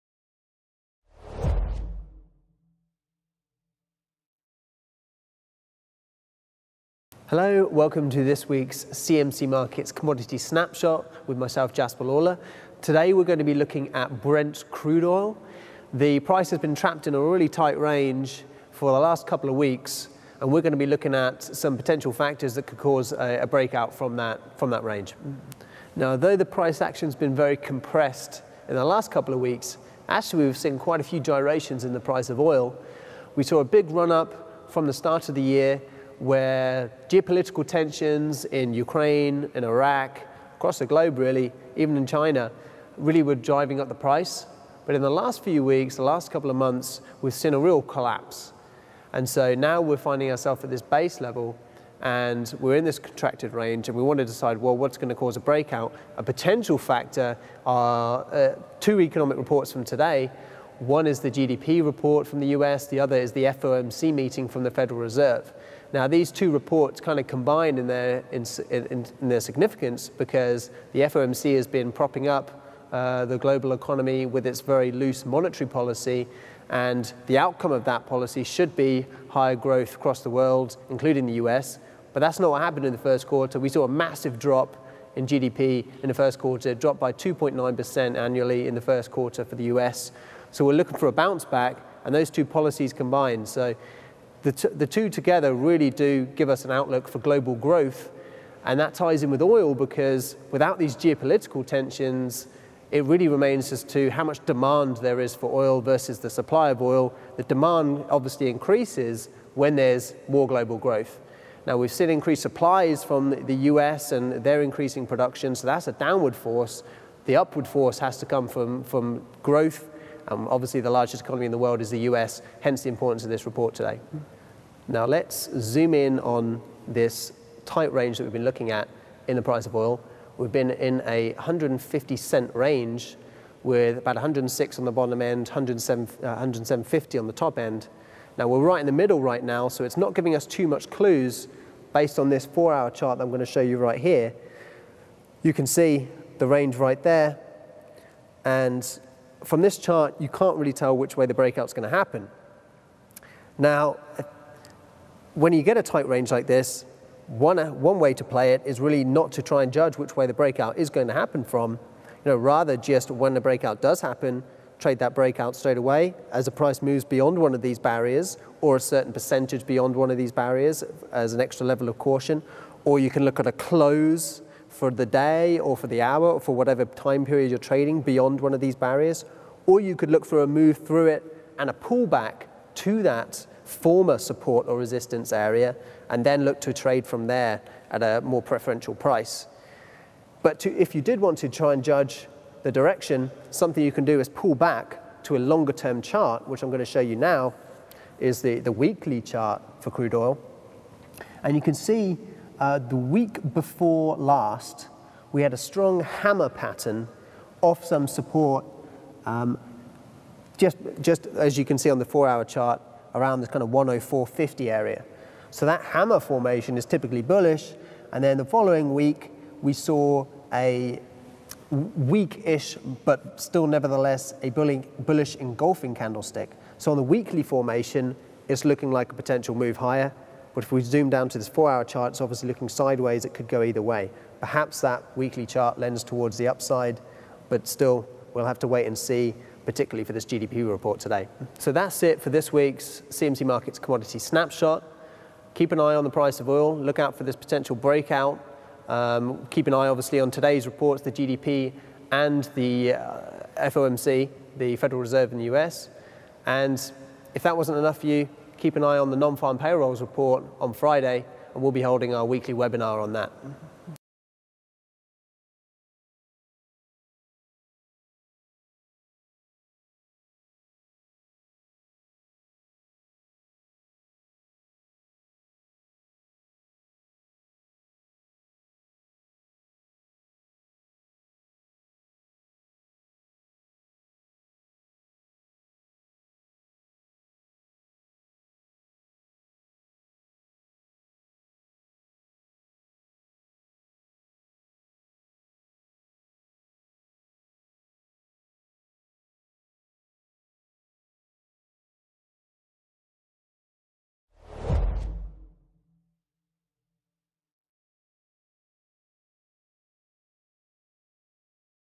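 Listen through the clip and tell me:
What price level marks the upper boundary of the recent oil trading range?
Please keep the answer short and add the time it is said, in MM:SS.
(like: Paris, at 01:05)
107.50, at 02:16.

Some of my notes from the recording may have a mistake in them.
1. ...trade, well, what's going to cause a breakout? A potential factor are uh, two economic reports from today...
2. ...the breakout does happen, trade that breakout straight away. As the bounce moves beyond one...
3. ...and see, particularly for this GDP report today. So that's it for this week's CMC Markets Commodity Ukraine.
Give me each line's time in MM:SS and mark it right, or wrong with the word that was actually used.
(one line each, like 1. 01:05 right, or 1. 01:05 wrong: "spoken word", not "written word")
1. 00:54 wrong: "decide", not "trade"
2. 02:43 wrong: "price", not "bounce"
3. 03:58 wrong: "Snapshot", not "Ukraine".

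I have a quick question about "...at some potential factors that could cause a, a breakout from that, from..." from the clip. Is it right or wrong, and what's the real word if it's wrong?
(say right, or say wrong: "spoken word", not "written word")
right.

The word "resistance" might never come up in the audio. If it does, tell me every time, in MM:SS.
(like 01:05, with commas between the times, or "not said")
03:04.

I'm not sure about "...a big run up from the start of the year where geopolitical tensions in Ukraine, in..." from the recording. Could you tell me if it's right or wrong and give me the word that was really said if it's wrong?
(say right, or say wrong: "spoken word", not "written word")
right.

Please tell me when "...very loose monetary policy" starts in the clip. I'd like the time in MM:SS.
01:14.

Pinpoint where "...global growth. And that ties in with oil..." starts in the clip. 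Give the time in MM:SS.
01:37.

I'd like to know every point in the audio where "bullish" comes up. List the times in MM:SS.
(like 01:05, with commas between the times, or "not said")
03:37, 03:44.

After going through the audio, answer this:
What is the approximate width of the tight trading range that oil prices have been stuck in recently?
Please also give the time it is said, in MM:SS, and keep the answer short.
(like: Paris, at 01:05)
150 cents, at 02:11.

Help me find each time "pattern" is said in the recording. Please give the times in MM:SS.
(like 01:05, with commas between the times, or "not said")
03:26.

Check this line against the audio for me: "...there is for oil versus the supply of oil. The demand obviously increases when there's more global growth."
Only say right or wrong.
right.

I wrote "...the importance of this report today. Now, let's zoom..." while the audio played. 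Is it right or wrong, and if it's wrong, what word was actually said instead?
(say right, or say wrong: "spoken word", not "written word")
right.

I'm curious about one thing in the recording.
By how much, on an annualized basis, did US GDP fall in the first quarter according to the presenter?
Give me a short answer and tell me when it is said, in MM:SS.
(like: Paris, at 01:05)
2.9%, at 01:27.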